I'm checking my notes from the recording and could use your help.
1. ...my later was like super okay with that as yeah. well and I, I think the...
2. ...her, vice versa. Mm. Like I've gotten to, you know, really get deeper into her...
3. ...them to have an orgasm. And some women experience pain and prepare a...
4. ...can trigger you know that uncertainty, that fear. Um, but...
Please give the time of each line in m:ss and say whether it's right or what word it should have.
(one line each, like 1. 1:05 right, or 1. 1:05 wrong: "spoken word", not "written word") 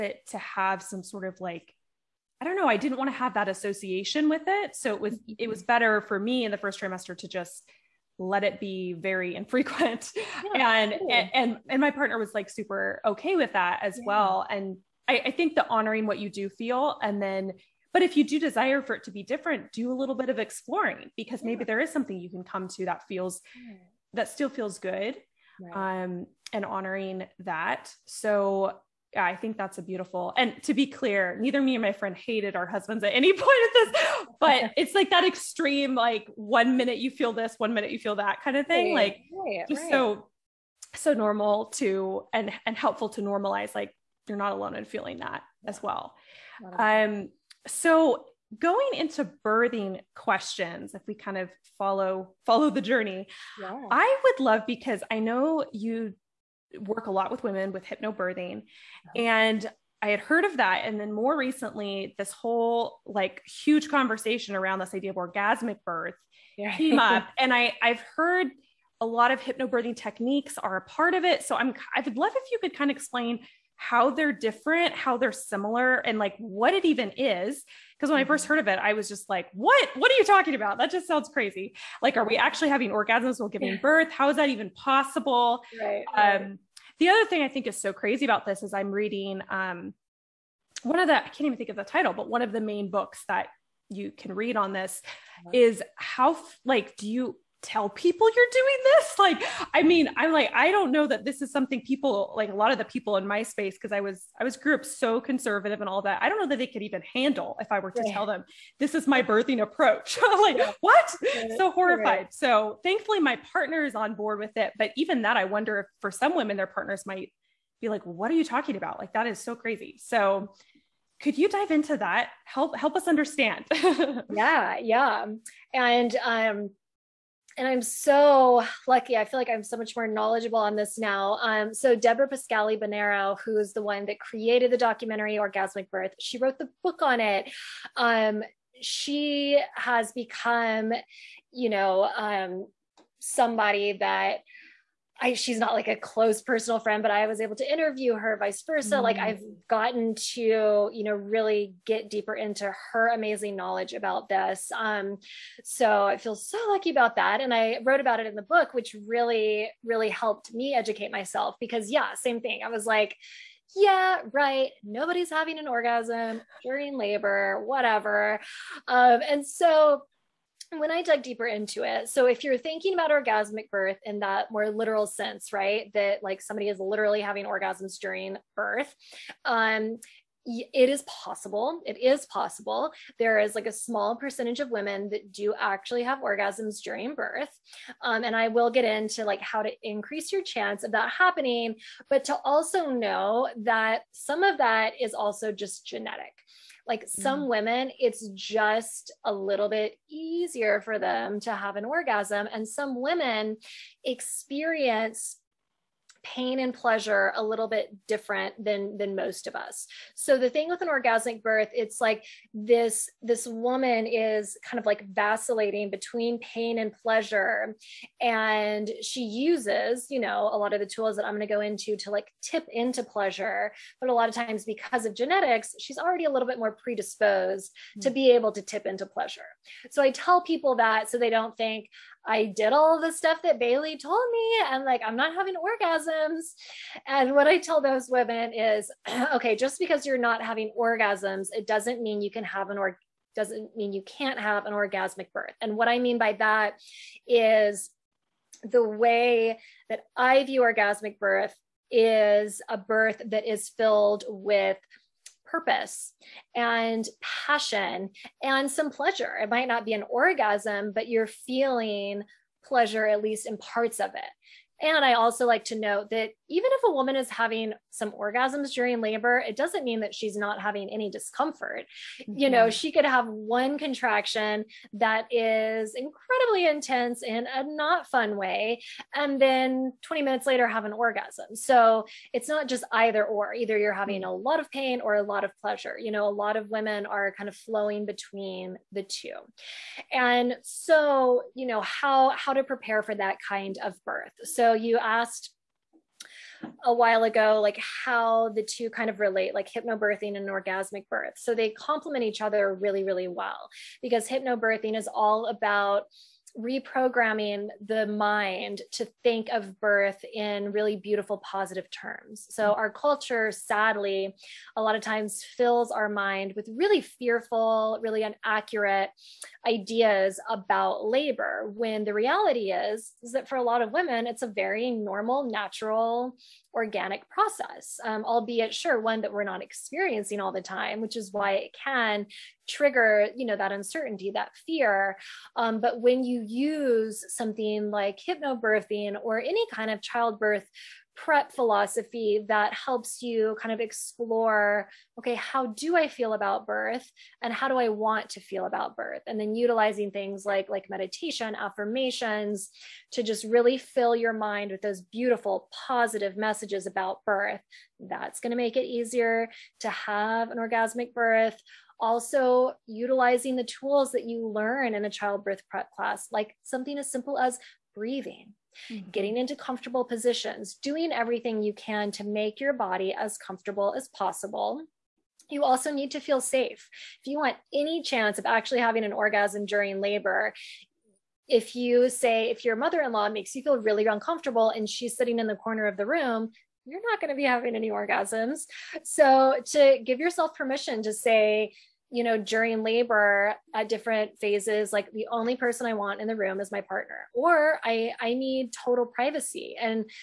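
1. 0:11 wrong: "partner", not "later"
2. 2:28 right
3. 3:20 wrong: "pleasure", not "prepare"
4. 5:31 right.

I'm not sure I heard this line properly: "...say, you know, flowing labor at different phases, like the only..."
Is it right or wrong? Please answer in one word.
wrong.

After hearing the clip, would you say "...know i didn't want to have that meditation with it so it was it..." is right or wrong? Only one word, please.
wrong.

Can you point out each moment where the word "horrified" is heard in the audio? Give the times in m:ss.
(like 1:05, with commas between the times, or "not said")
1:51.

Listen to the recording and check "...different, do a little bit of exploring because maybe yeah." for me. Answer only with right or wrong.
right.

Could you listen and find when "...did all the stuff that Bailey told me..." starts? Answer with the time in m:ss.
3:52.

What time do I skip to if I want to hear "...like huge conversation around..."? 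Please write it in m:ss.
1:03.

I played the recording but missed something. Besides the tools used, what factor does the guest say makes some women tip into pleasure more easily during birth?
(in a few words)
genetics.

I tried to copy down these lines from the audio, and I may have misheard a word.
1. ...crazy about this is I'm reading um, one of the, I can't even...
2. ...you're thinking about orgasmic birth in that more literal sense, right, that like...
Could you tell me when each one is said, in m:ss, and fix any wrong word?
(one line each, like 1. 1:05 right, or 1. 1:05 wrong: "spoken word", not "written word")
1. 1:27 right
2. 2:52 right.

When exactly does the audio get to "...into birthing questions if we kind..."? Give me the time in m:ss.
0:48.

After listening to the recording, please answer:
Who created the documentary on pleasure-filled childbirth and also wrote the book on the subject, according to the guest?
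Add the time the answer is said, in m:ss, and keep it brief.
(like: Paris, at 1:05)
Deborah Pascali Bonaro, at 2:11.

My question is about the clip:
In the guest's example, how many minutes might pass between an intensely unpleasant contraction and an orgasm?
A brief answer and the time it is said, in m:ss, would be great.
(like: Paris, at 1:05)
20, at 4:40.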